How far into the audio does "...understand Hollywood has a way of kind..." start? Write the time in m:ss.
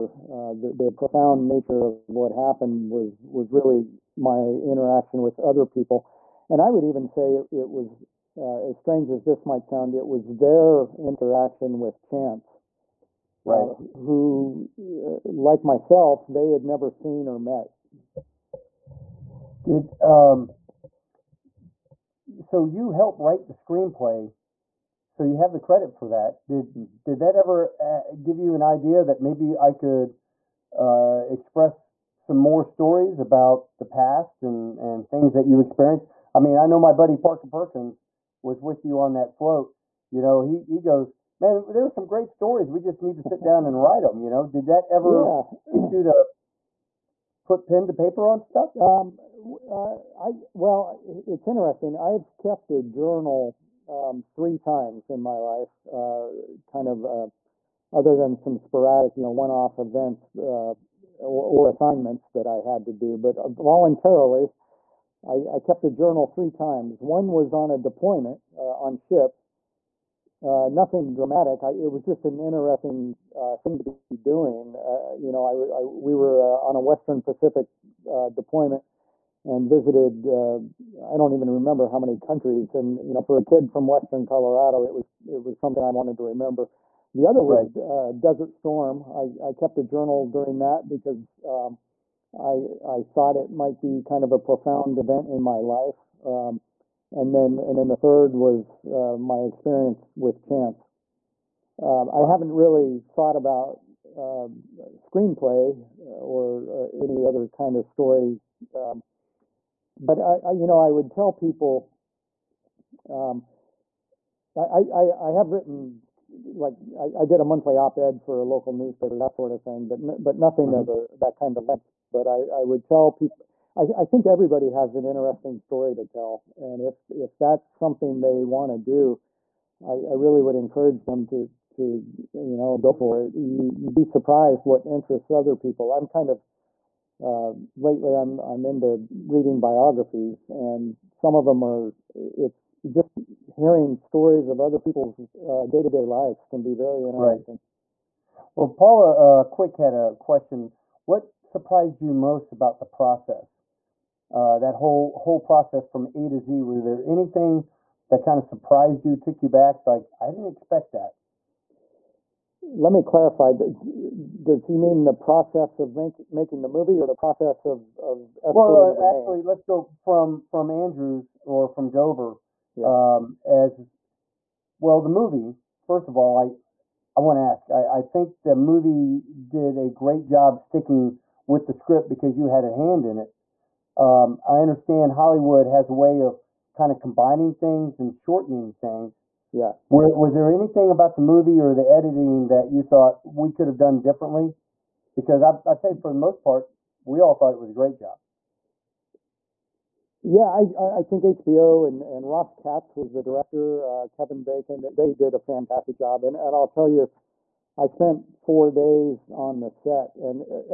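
3:04.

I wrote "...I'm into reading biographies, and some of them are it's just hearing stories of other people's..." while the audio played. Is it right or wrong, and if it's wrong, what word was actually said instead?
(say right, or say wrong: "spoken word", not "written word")
right.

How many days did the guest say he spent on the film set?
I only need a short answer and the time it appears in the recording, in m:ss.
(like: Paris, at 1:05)
4, at 3:28.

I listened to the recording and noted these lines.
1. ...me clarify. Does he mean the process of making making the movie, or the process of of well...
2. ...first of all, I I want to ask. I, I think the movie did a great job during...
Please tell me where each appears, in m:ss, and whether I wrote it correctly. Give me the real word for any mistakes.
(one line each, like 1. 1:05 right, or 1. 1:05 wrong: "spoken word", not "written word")
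1. 2:42 right
2. 2:55 wrong: "sticking", not "during".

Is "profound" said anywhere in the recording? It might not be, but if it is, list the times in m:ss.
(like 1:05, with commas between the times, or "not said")
0:00, 1:34.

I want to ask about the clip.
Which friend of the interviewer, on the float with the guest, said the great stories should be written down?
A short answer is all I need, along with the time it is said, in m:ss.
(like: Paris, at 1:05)
Parker Perkins, at 0:37.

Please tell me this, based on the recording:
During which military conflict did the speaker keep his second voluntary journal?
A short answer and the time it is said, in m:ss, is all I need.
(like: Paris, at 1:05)
Desert Storm, at 1:28.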